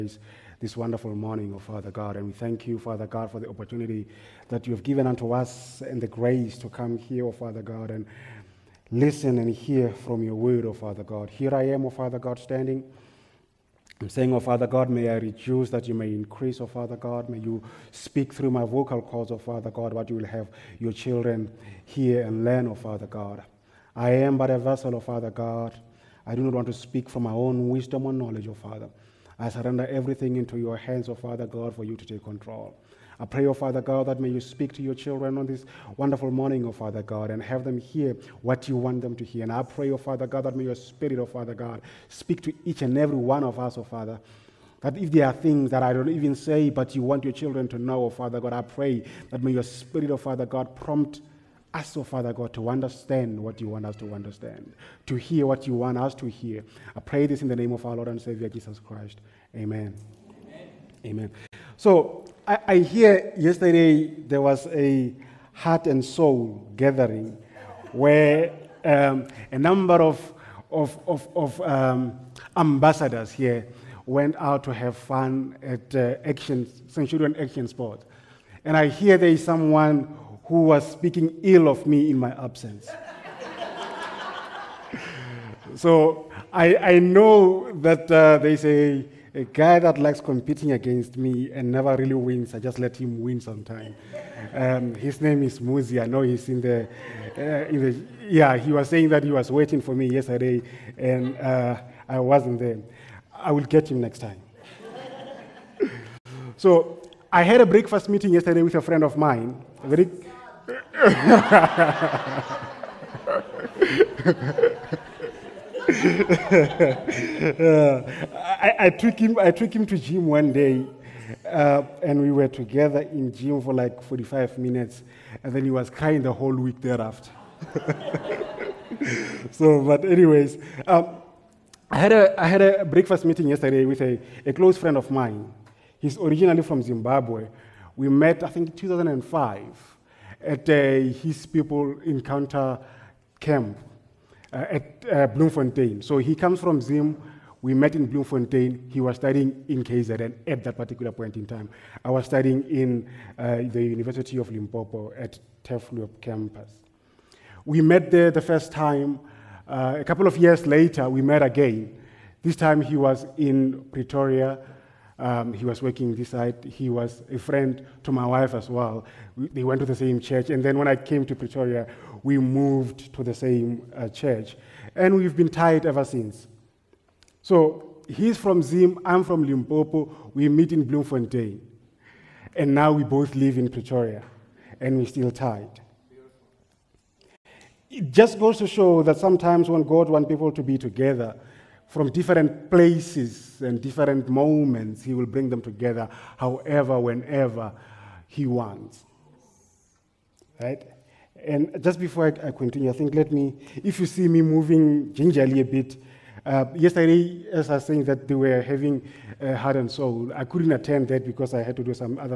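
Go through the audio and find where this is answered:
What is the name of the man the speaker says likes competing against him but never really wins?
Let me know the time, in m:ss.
1:35.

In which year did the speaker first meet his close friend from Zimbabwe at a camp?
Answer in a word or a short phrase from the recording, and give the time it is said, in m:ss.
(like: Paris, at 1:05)
2005, at 2:18.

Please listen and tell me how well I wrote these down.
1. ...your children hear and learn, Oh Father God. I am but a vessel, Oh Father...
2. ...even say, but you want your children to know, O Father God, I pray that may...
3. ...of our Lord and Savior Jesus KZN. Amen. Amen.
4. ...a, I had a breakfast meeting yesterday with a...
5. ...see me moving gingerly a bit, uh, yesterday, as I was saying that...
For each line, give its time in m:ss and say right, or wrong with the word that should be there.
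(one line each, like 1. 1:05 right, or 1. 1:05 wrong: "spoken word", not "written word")
1. 0:20 right
2. 0:46 right
3. 0:57 wrong: "Christ", not "KZN"
4. 2:12 right
5. 3:24 right.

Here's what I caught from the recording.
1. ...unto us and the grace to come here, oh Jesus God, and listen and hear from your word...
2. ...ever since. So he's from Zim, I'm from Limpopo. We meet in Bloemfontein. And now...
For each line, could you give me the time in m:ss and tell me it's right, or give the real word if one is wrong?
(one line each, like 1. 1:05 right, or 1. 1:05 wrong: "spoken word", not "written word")
1. 0:05 wrong: "Father", not "Jesus"
2. 2:55 right.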